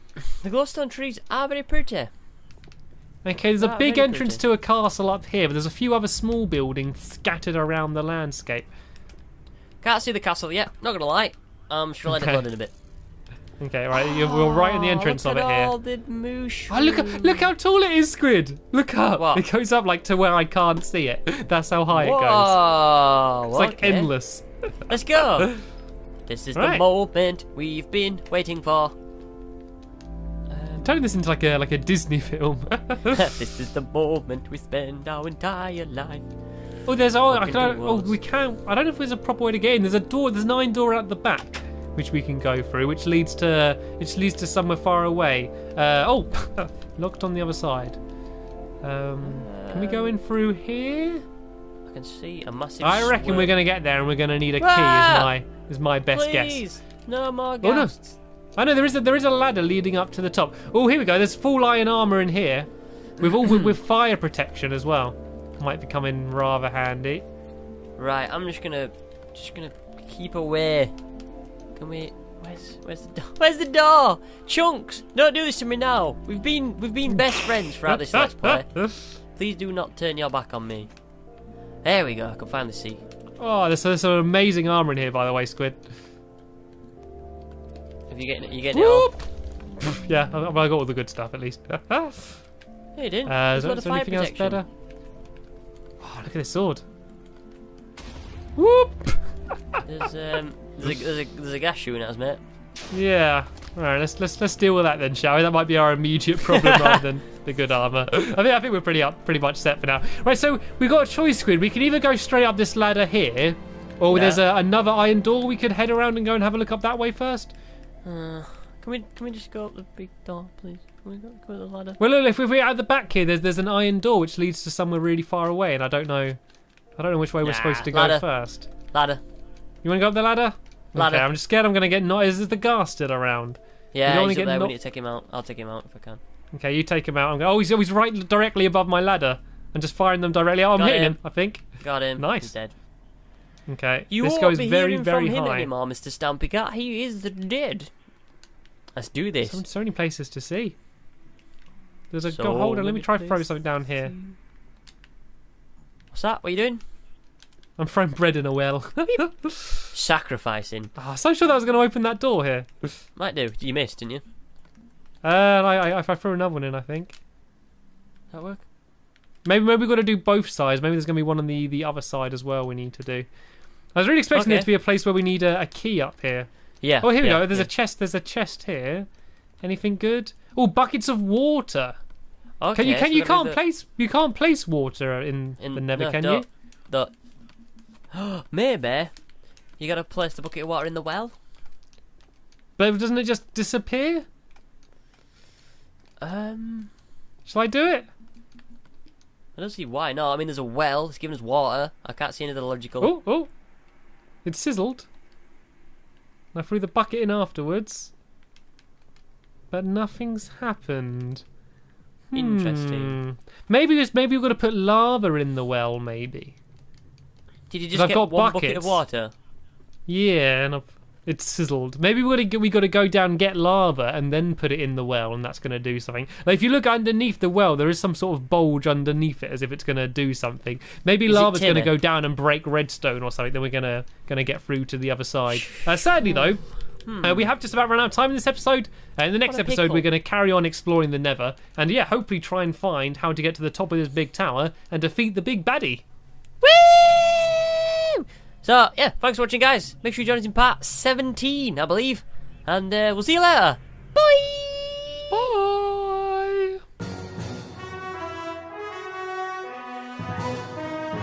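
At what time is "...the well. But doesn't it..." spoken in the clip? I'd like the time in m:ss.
3:10.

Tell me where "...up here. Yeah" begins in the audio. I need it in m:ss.
2:56.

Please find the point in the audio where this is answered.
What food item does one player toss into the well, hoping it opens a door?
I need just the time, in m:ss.
2:38.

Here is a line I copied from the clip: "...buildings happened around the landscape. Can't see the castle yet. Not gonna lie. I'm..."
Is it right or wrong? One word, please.
wrong.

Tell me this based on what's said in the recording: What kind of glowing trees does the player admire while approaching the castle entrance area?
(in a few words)
Glowstone trees.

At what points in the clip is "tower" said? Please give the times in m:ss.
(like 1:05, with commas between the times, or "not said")
4:04.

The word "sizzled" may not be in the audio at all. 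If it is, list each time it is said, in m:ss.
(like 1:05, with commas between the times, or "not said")
3:24, 3:41.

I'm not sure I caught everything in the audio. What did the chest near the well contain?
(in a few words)
Buckets of water.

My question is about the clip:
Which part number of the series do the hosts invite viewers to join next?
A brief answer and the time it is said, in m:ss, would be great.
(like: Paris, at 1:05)
17, at 4:10.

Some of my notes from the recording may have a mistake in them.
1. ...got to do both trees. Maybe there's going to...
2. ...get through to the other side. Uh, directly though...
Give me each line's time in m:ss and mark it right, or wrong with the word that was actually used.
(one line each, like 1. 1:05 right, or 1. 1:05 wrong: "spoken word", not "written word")
1. 2:49 wrong: "sides", not "trees"
2. 3:54 wrong: "sadly", not "directly".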